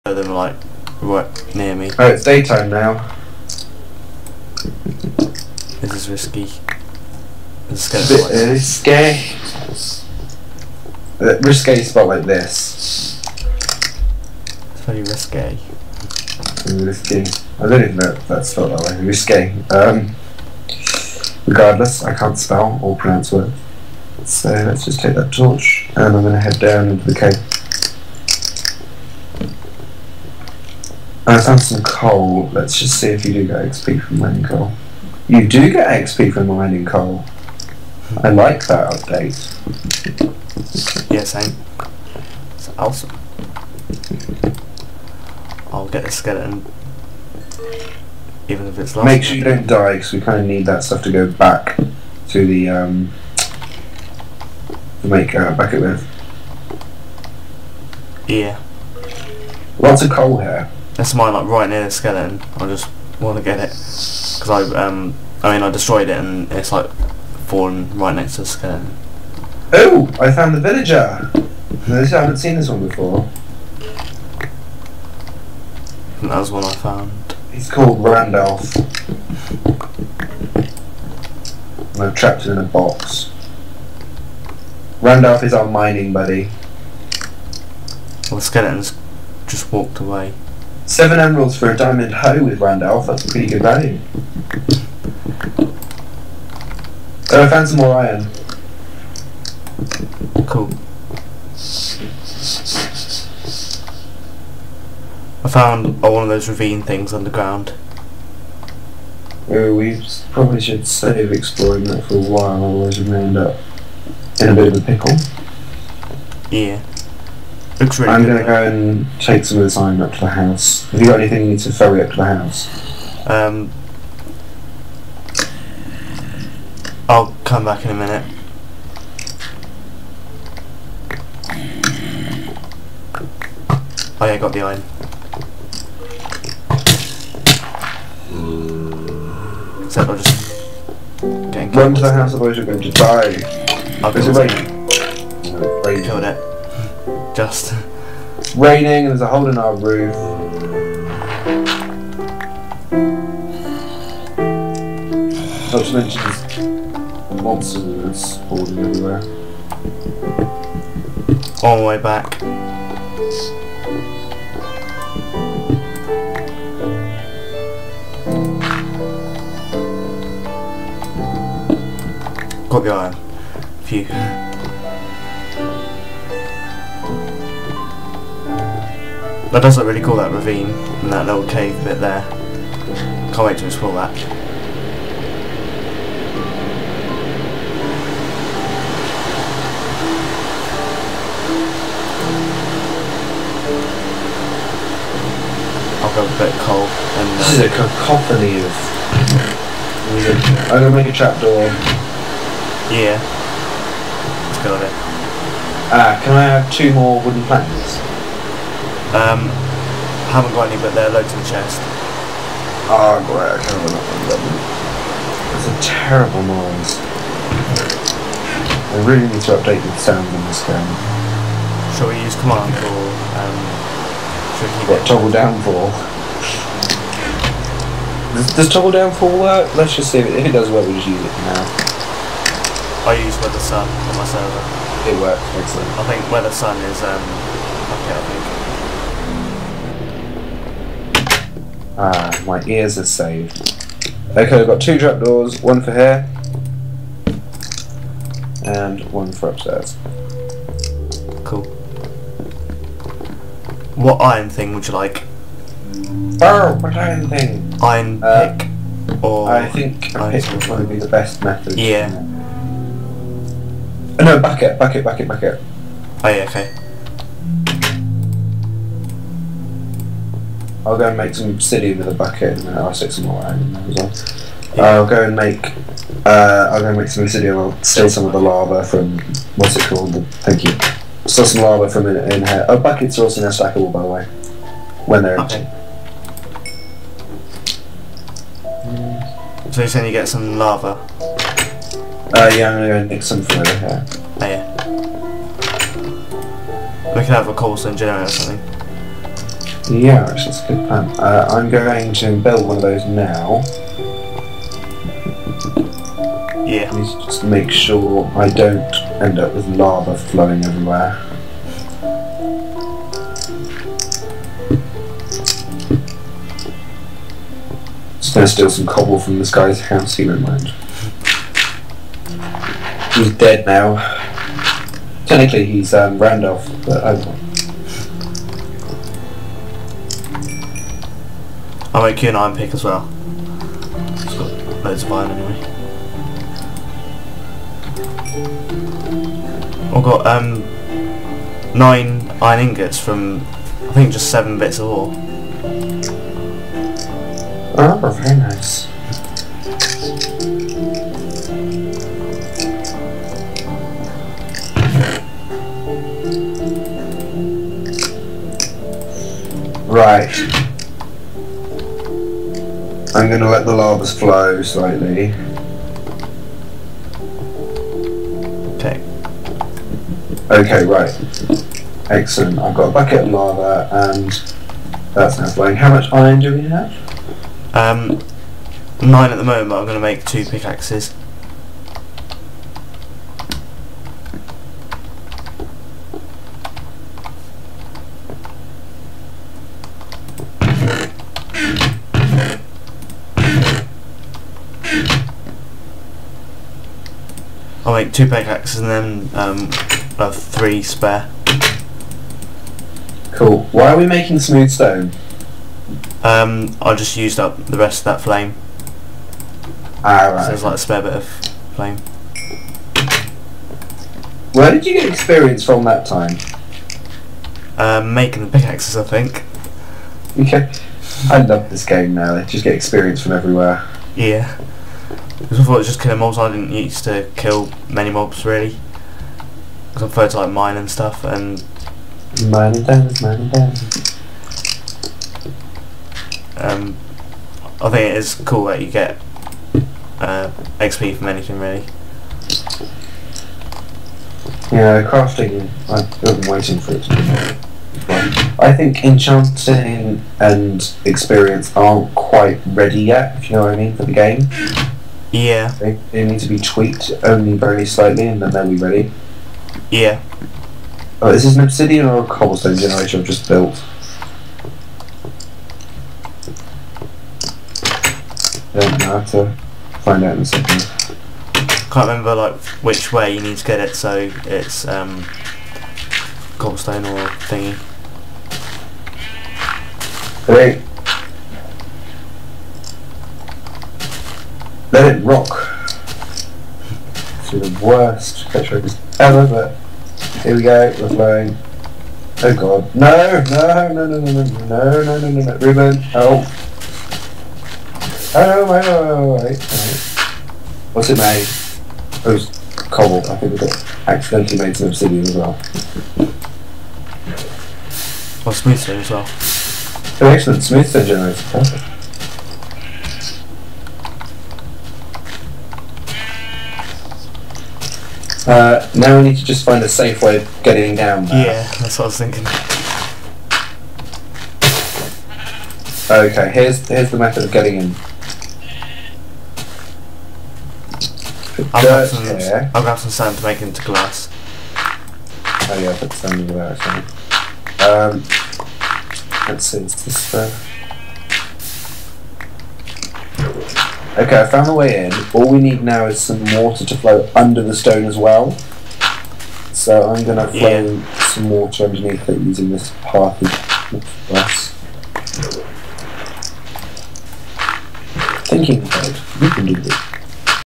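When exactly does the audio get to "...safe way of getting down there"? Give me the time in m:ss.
8:39.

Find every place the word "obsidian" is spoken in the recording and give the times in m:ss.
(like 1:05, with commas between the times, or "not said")
4:31, 4:37, 7:41, 8:24.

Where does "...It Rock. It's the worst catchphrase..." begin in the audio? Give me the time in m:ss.
8:05.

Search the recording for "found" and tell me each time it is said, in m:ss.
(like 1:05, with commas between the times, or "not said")
1:10, 1:16, 1:37, 1:45, 9:04.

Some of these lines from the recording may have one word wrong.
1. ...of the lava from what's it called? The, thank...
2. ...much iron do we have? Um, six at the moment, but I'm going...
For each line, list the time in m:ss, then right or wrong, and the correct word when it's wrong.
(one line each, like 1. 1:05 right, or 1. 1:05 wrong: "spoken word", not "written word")
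1. 4:38 right
2. 6:15 wrong: "nine", not "six".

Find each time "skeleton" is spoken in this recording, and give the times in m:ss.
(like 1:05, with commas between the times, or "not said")
0:46, 1:01, 1:08, 1:28.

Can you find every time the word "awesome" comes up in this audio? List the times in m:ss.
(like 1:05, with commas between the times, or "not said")
0:42.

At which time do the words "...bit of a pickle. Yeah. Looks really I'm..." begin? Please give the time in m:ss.
1:54.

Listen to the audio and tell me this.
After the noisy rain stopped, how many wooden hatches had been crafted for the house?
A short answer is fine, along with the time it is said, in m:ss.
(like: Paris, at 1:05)
2, at 4:04.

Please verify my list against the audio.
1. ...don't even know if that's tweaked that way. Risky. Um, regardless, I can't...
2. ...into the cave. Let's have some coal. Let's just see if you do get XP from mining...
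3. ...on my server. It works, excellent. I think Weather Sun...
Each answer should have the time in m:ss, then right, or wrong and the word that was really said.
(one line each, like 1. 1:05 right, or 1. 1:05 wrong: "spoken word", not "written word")
1. 0:17 wrong: "spelled", not "tweaked"
2. 0:26 right
3. 3:53 right.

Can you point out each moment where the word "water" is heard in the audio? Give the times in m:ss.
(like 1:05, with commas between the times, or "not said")
9:06, 9:11.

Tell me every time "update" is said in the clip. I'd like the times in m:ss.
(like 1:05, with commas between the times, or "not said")
0:38, 3:39.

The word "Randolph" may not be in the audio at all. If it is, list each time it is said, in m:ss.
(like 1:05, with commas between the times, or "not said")
1:18, 1:25, 5:26.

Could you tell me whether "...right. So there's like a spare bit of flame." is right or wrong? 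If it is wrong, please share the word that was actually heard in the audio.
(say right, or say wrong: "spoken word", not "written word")
right.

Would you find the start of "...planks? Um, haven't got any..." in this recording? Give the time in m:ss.
3:27.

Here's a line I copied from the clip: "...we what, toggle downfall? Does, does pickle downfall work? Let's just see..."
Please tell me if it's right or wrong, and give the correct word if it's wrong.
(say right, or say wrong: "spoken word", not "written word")
wrong: "toggle", not "pickle".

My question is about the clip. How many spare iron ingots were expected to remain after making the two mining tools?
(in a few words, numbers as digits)
3.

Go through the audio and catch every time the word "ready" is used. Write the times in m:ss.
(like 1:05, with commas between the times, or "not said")
7:32, 7:38.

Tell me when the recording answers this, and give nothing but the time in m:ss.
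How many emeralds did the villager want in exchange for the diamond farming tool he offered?
1:30.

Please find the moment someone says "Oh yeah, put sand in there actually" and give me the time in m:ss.
8:55.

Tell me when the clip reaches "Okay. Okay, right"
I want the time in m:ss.
6:08.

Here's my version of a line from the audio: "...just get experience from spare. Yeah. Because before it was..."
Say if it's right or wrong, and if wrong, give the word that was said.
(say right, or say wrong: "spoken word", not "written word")
wrong: "everywhere", not "spare".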